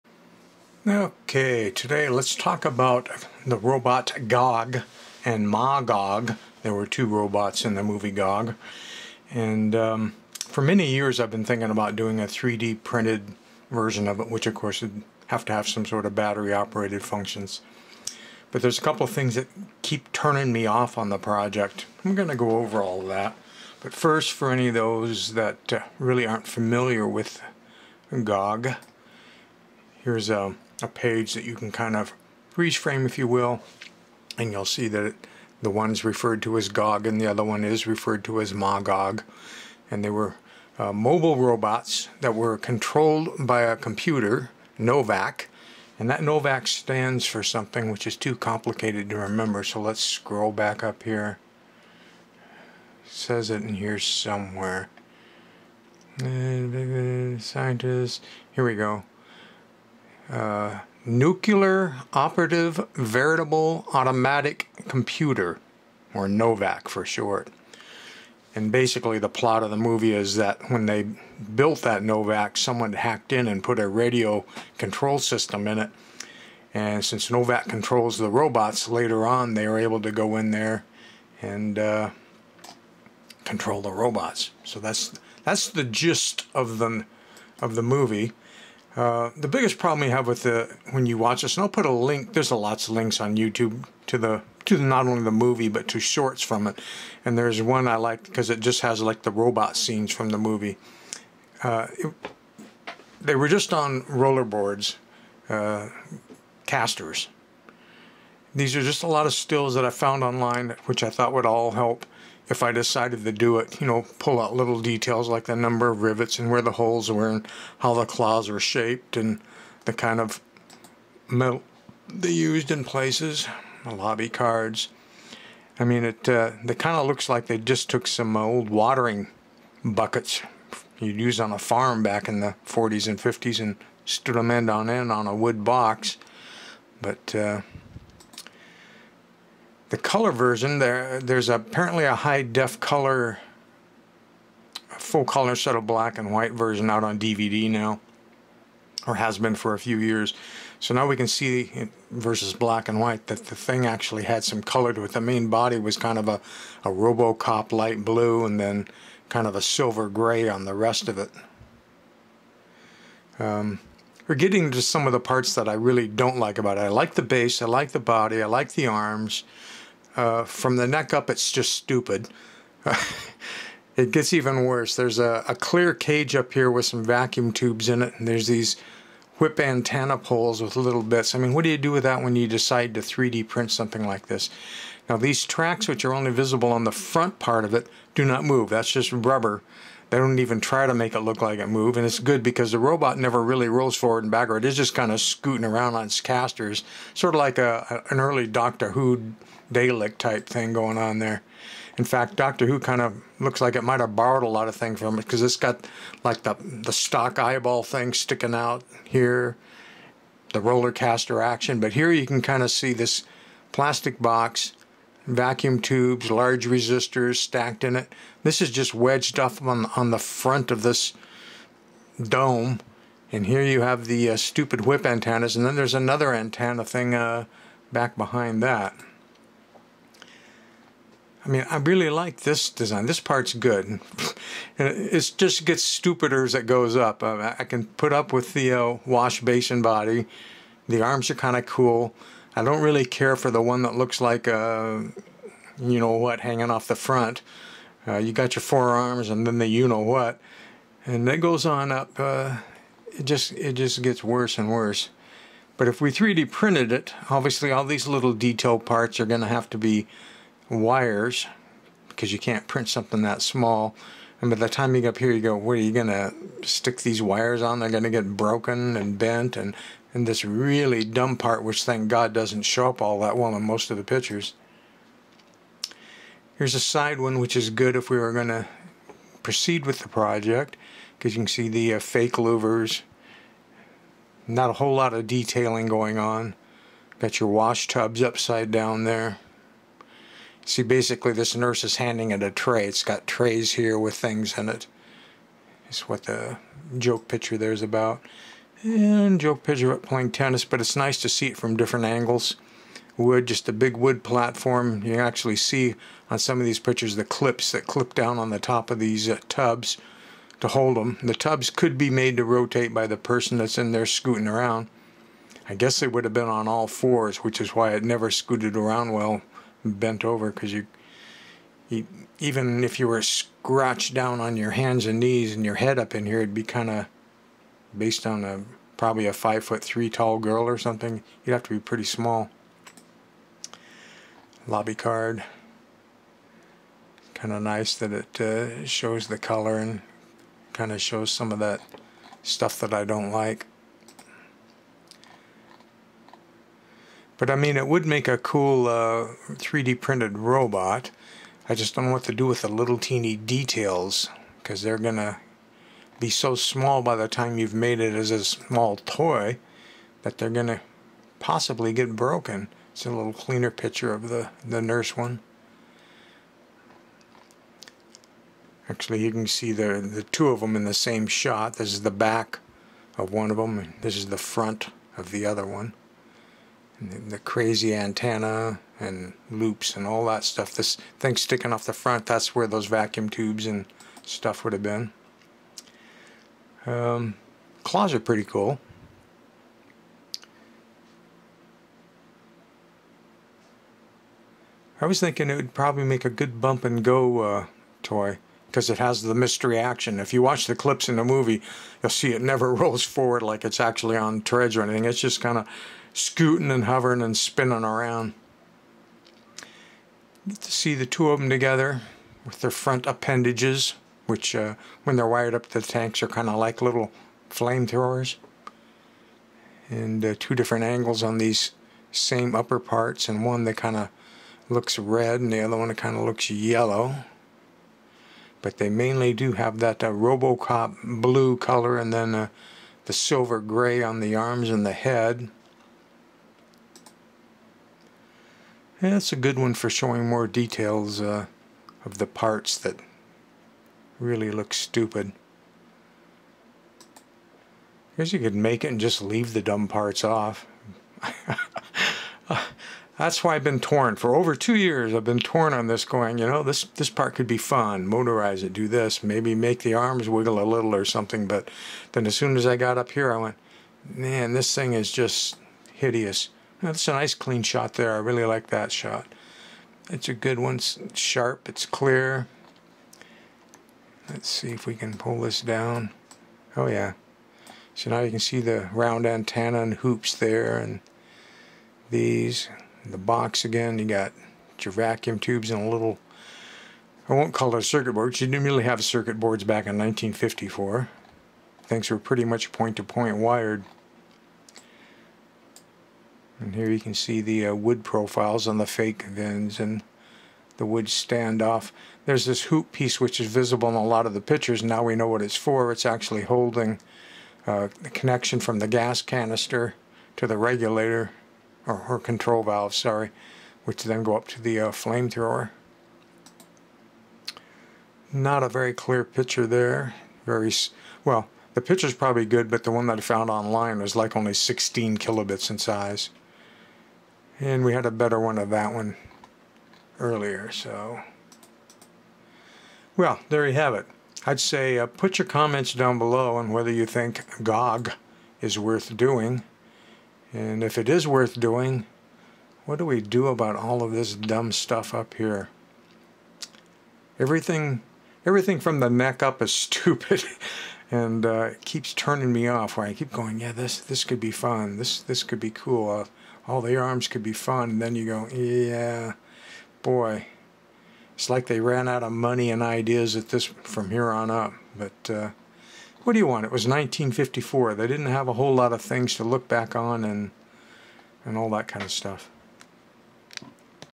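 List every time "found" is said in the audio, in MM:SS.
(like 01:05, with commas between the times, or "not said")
01:49, 08:43.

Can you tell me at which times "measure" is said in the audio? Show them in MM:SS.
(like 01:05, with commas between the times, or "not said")
not said.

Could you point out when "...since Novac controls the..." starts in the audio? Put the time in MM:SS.
01:17.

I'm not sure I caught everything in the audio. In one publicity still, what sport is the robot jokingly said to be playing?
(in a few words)
tennis.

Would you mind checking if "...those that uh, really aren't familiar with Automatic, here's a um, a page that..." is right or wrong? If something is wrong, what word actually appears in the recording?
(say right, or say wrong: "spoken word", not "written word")
wrong: "Gog", not "Automatic".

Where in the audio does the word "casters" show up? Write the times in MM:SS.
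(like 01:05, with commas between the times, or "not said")
01:46, 03:16, 03:30.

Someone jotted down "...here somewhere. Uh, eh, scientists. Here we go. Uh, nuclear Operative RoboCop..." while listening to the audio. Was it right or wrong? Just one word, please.
wrong.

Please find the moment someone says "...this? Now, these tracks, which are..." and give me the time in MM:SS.
03:04.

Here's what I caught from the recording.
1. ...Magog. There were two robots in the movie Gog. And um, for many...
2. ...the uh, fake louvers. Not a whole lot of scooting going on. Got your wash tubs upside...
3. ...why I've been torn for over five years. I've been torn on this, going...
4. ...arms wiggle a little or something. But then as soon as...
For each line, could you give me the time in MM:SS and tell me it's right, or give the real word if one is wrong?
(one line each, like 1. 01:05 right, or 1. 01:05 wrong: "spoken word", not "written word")
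1. 00:05 right
2. 04:41 wrong: "detailing", not "scooting"
3. 07:33 wrong: "two", not "five"
4. 07:39 right.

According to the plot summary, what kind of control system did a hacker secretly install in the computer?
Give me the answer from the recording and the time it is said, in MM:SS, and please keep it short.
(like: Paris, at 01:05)
radio control system, at 01:13.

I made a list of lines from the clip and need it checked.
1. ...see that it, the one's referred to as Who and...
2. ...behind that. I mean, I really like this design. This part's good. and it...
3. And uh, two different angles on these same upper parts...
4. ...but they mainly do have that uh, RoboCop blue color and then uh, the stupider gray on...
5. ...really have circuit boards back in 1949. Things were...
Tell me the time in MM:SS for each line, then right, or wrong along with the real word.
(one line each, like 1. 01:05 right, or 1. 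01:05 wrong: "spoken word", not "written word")
1. 00:34 wrong: "Gog", not "Who"
2. 03:48 right
3. 06:59 right
4. 07:08 wrong: "silver", not "stupider"
5. 08:08 wrong: "1954", not "1949".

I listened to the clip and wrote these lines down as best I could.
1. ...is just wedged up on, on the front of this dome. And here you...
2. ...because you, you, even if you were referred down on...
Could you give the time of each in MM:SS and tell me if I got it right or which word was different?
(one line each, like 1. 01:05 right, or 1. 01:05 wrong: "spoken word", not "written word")
1. 03:38 right
2. 05:20 wrong: "scratched", not "referred".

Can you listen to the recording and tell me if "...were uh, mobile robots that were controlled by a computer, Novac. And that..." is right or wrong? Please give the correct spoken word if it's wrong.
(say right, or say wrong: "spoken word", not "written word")
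right.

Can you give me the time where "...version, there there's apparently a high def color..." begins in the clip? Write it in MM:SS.
02:20.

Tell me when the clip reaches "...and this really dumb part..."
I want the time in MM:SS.
04:30.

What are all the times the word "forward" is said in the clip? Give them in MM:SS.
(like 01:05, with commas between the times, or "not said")
03:13, 06:43.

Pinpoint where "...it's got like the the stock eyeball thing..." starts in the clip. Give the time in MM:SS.
03:25.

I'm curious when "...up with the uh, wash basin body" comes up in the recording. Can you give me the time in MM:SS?
03:58.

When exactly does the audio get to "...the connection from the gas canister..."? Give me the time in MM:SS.
08:28.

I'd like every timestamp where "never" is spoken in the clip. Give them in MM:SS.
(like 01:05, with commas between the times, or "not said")
03:13, 05:18, 06:42.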